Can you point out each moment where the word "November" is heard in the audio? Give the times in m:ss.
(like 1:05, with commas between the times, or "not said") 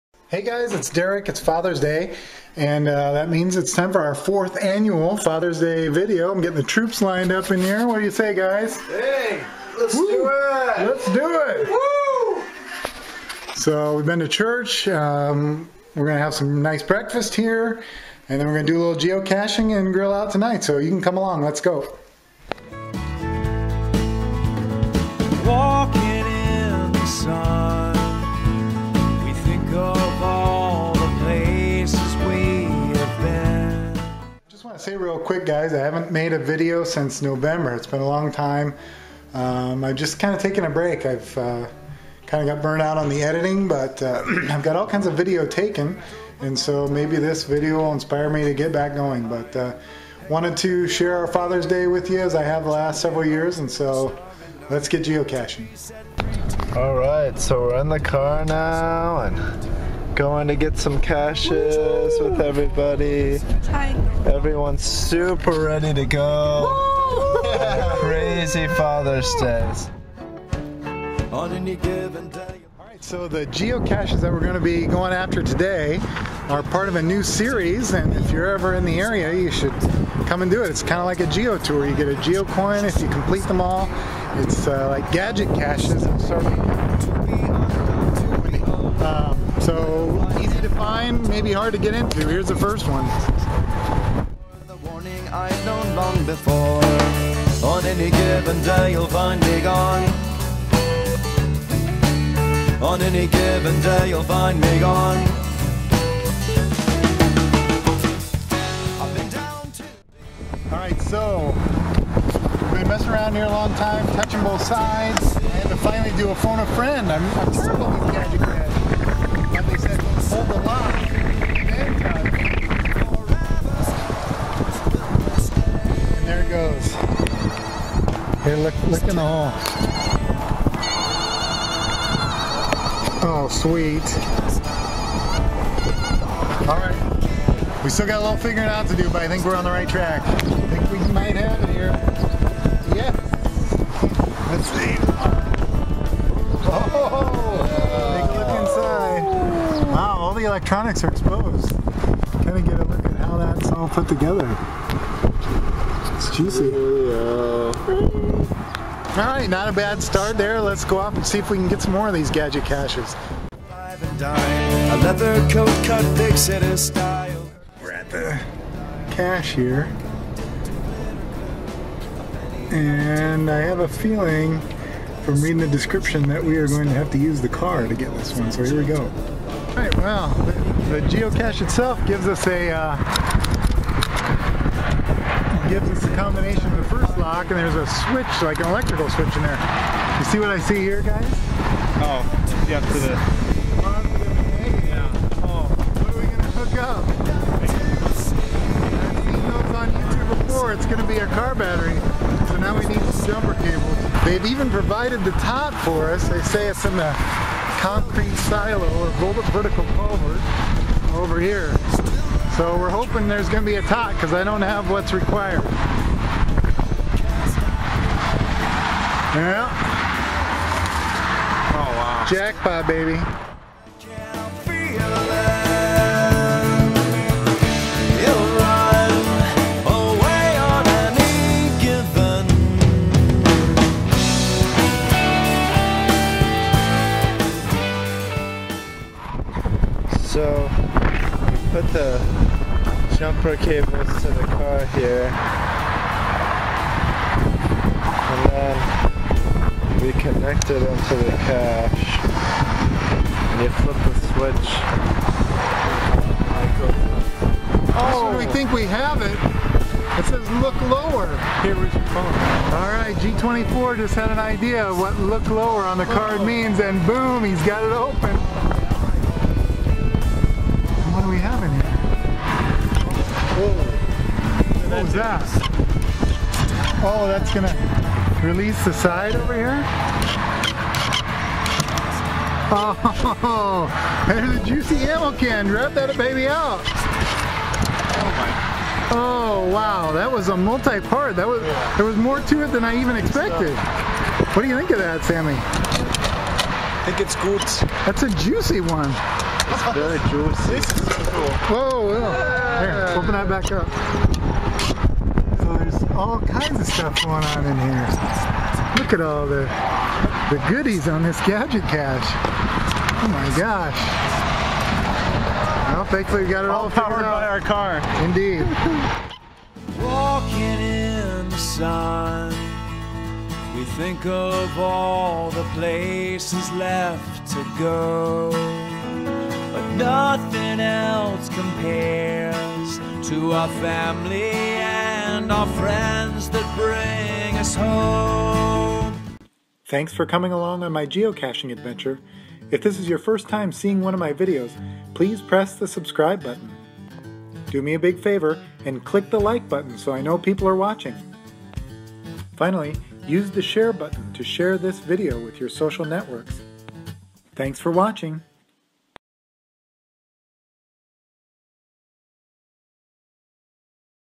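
0:37.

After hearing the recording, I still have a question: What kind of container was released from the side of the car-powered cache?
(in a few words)
ammo can.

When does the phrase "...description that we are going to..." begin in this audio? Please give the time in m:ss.
2:55.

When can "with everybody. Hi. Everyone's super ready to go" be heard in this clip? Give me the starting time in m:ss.
1:02.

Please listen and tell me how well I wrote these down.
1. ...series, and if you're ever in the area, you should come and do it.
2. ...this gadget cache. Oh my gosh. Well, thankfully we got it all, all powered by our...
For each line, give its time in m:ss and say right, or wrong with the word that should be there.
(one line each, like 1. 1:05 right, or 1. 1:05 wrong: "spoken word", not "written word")
1. 1:17 right
2. 5:11 right.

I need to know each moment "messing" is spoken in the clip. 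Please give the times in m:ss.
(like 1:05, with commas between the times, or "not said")
1:52.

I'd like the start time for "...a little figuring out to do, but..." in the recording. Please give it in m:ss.
2:18.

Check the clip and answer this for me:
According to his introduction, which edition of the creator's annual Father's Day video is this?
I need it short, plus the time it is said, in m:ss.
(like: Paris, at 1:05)
fourth, at 0:04.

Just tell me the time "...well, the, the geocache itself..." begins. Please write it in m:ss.
2:59.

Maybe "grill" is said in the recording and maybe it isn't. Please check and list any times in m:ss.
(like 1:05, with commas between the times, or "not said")
0:19.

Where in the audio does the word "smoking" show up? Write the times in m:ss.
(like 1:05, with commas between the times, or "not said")
not said.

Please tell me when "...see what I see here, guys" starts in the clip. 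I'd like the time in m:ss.
3:10.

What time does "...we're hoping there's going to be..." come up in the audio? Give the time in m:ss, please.
3:32.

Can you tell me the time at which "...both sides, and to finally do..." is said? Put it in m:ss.
1:54.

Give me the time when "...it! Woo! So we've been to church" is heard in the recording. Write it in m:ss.
0:11.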